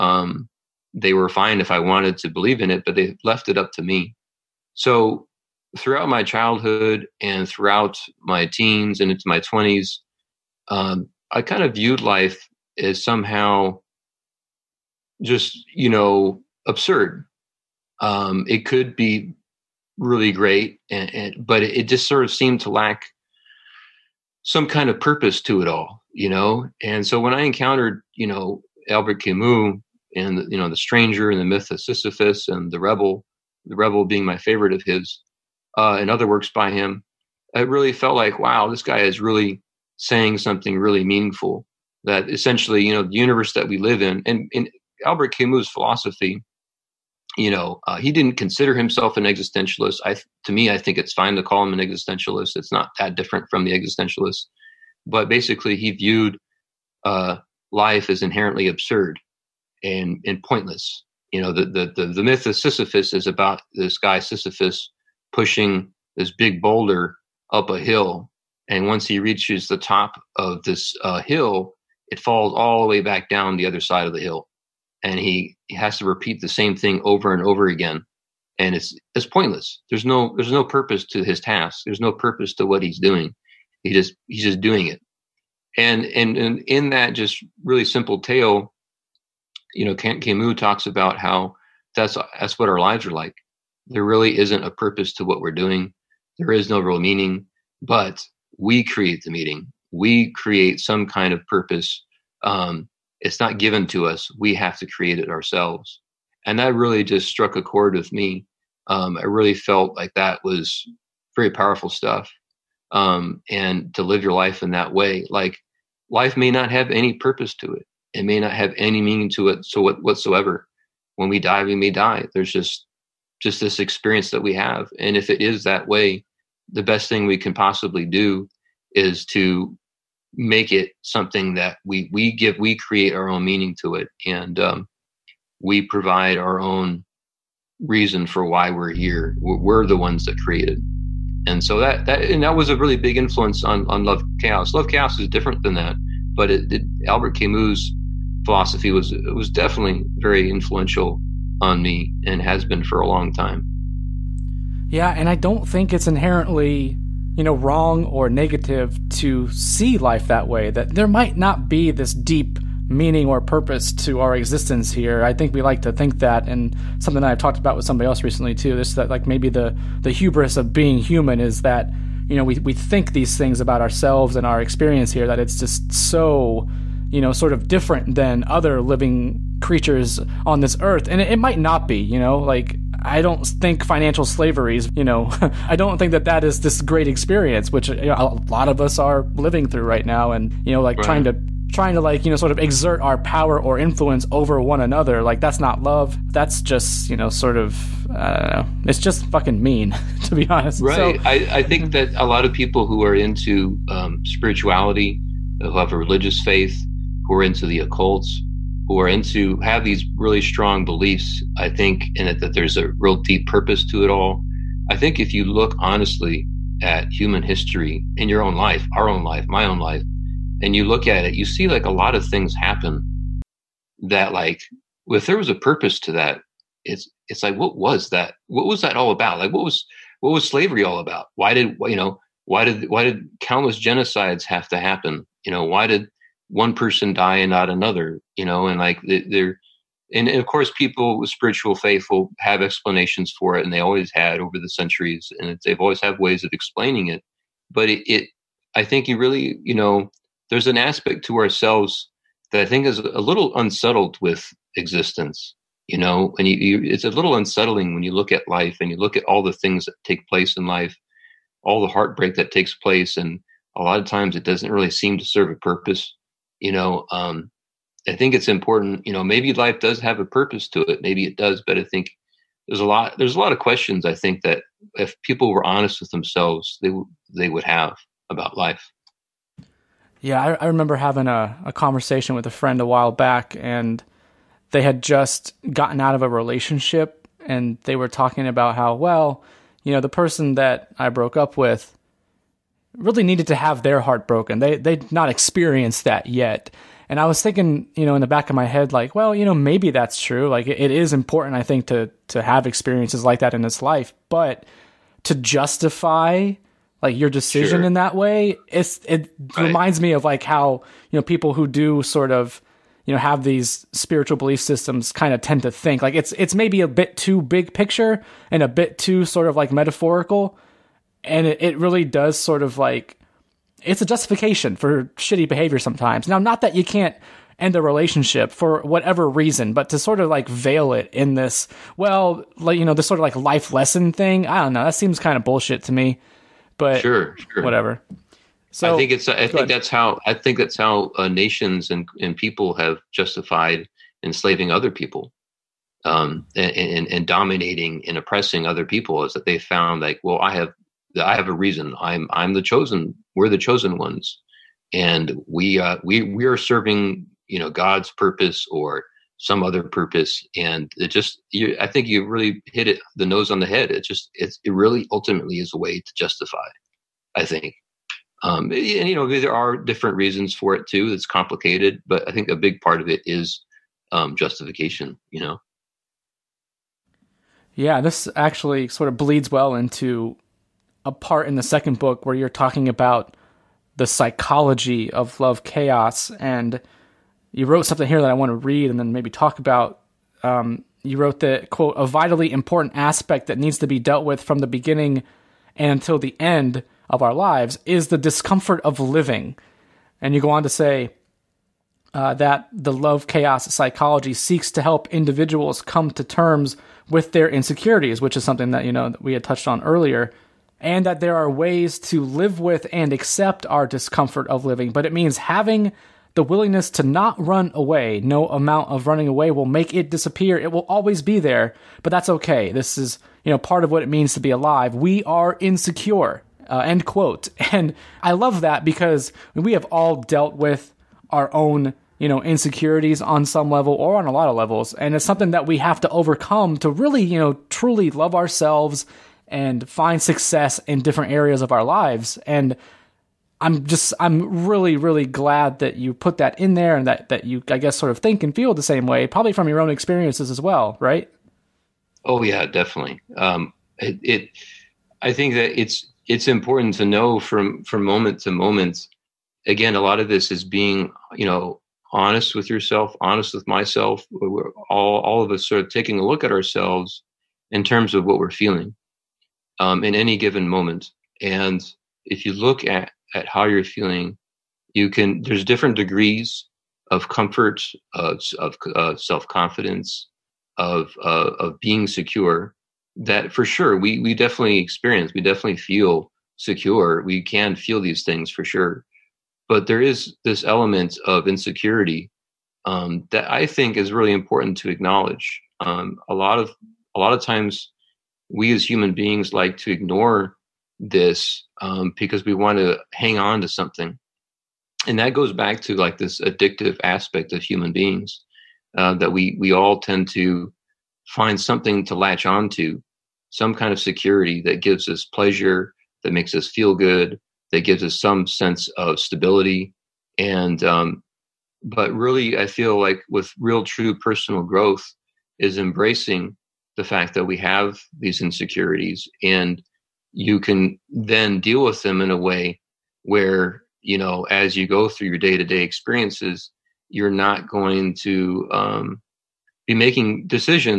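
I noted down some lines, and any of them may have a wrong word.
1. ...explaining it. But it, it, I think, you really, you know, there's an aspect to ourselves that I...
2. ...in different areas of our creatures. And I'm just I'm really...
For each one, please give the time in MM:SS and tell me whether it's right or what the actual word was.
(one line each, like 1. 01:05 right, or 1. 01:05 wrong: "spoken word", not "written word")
1. 04:06 right
2. 07:20 wrong: "lives", not "creatures".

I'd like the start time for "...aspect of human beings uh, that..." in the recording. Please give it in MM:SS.
08:27.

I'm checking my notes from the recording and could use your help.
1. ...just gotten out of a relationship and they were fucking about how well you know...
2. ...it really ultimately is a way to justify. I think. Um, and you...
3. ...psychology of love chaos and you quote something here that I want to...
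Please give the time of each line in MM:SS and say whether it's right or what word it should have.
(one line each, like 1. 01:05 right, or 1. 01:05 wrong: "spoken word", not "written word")
1. 04:45 wrong: "talking", not "fucking"
2. 06:04 right
3. 06:24 wrong: "wrote", not "quote".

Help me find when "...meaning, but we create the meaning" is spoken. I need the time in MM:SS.
01:36.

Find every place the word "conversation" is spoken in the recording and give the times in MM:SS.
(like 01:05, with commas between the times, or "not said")
04:41.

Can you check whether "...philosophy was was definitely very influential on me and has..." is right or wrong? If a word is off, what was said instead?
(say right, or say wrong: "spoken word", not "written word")
right.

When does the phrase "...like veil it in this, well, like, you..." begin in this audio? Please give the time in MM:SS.
05:30.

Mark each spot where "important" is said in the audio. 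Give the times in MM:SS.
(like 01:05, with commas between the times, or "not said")
04:28, 05:01, 06:32, 07:36, 08:14.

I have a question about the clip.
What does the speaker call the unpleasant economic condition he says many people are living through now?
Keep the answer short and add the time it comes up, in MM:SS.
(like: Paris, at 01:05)
financial slavery, at 03:03.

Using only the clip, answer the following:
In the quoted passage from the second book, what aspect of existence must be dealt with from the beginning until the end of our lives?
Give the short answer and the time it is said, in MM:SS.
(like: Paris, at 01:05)
the discomfort of living, at 06:38.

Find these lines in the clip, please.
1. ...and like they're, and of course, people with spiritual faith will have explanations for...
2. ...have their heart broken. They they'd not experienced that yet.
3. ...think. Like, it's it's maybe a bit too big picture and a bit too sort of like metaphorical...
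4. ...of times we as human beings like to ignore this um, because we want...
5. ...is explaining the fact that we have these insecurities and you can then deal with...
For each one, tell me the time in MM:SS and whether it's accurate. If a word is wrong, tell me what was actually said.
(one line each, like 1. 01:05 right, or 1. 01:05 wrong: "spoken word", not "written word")
1. 03:58 right
2. 04:53 right
3. 05:15 right
4. 08:17 right
5. 08:45 wrong: "embracing", not "explaining".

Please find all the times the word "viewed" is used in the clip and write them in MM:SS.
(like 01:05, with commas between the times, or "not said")
00:11, 00:55.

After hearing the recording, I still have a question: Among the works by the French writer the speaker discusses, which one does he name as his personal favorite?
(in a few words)
The Rebel.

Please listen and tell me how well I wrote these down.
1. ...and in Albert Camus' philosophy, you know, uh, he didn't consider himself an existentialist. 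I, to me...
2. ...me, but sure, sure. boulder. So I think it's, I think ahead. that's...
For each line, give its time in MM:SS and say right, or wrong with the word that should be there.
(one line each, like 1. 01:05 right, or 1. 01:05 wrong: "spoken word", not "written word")
1. 00:44 right
2. 05:35 wrong: "whatever", not "boulder".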